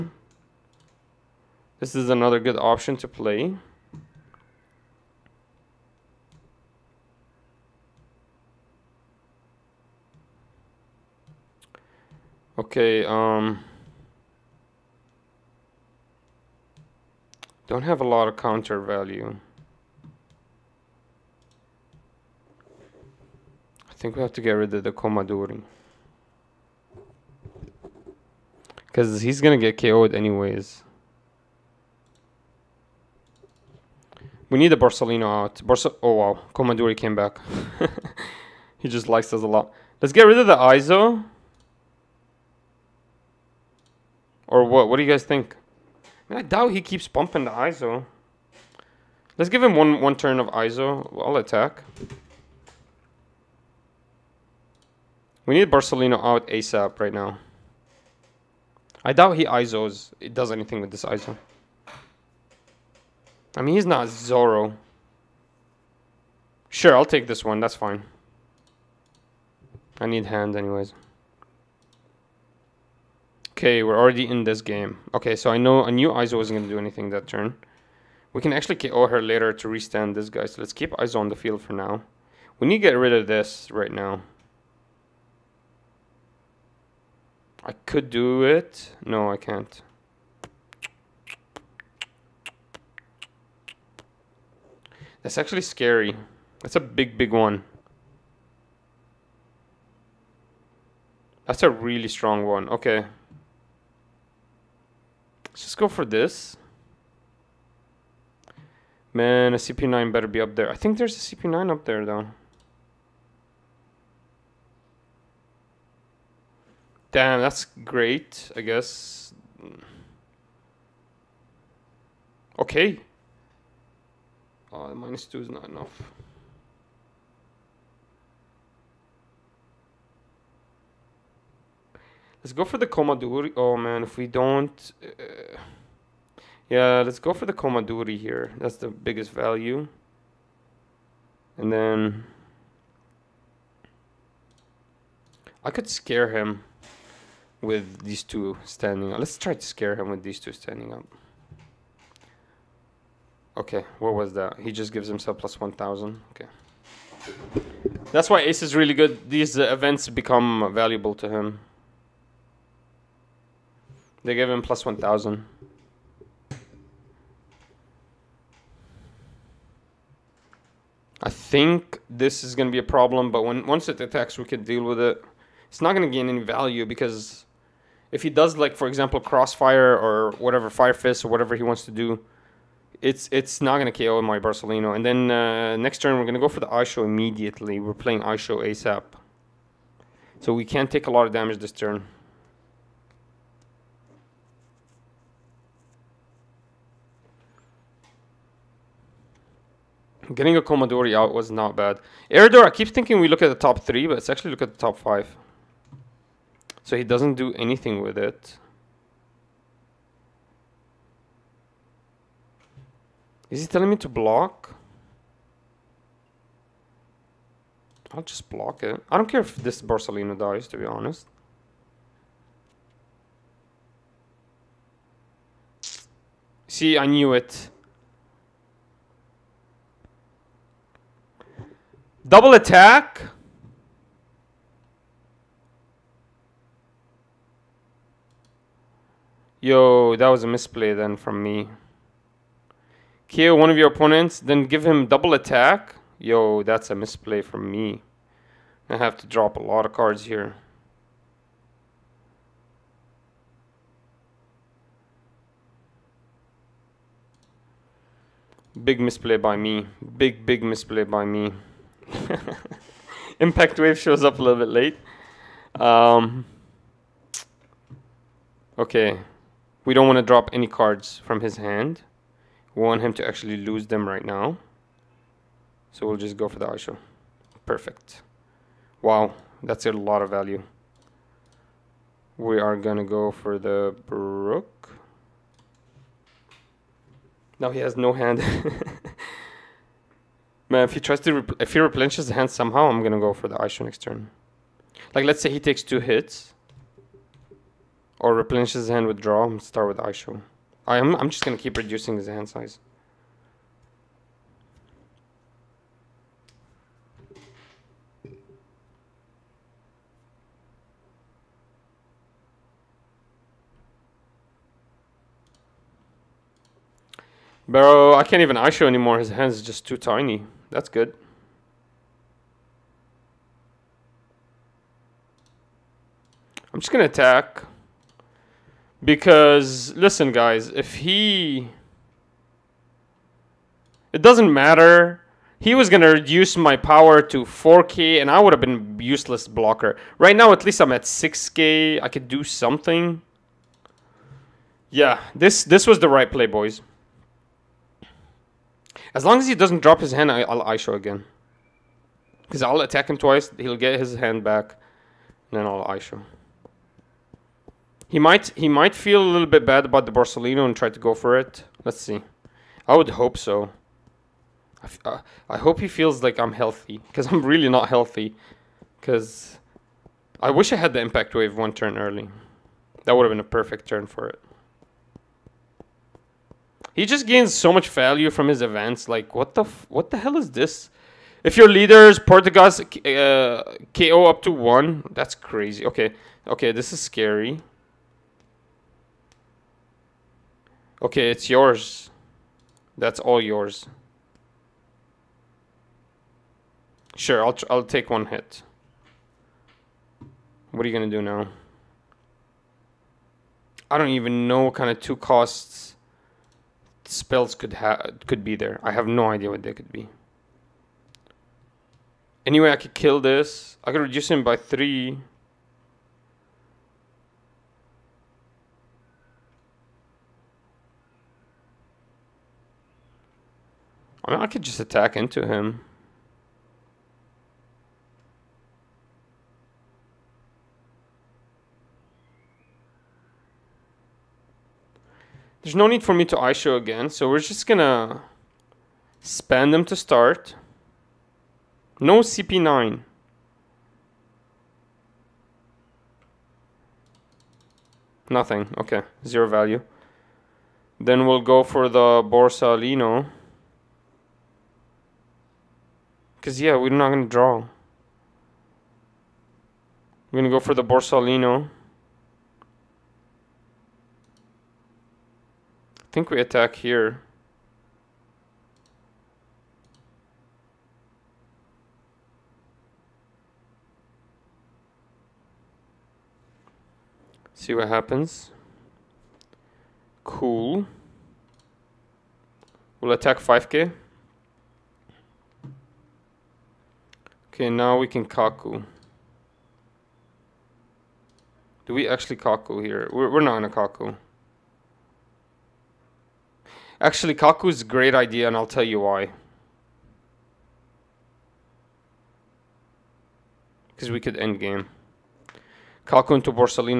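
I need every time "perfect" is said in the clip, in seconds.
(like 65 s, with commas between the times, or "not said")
277 s, 373 s.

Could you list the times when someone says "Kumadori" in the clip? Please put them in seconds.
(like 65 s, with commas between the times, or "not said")
24 s, 36 s, 132 s, 137 s, 200 s.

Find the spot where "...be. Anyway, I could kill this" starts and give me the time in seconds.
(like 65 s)
409 s.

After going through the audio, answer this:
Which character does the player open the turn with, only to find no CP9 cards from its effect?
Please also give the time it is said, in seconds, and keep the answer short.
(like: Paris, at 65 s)
Spandam, at 439 s.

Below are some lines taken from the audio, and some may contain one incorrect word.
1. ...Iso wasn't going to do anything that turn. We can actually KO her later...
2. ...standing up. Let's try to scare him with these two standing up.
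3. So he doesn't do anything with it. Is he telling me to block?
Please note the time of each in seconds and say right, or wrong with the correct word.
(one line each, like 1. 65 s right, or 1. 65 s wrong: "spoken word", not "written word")
1. 76 s right
2. 148 s right
3. 206 s right.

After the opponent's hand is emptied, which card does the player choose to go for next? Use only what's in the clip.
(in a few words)
Brook.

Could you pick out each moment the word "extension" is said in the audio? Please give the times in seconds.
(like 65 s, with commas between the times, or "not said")
not said.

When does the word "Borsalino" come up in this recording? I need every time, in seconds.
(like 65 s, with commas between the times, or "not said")
34 s, 55 s, 184 s, 219 s, 360 s, 452 s, 460 s, 506 s.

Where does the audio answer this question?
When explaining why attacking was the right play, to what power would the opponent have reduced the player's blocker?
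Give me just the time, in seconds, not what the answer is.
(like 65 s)
337 s.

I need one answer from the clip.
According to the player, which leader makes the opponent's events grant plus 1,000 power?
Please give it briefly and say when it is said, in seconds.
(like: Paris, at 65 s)
Ace, at 158 s.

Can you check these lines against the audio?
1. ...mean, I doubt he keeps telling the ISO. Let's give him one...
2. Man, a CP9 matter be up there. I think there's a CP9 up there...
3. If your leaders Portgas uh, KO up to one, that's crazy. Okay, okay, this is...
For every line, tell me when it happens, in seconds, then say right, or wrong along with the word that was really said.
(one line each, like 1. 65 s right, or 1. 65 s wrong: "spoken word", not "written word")
1. 46 s wrong: "pumping", not "telling"
2. 109 s wrong: "better", not "matter"
3. 381 s right.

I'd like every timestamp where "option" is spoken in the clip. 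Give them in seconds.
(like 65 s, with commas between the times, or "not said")
2 s.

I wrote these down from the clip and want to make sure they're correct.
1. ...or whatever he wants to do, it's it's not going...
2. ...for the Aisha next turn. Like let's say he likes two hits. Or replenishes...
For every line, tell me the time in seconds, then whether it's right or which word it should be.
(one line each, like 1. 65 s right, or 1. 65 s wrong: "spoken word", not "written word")
1. 181 s right
2. 293 s wrong: "takes", not "likes".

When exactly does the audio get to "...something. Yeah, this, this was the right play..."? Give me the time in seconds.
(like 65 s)
342 s.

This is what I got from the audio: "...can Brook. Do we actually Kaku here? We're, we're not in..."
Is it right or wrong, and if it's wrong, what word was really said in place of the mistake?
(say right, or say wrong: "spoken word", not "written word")
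wrong: "Kaku", not "Brook".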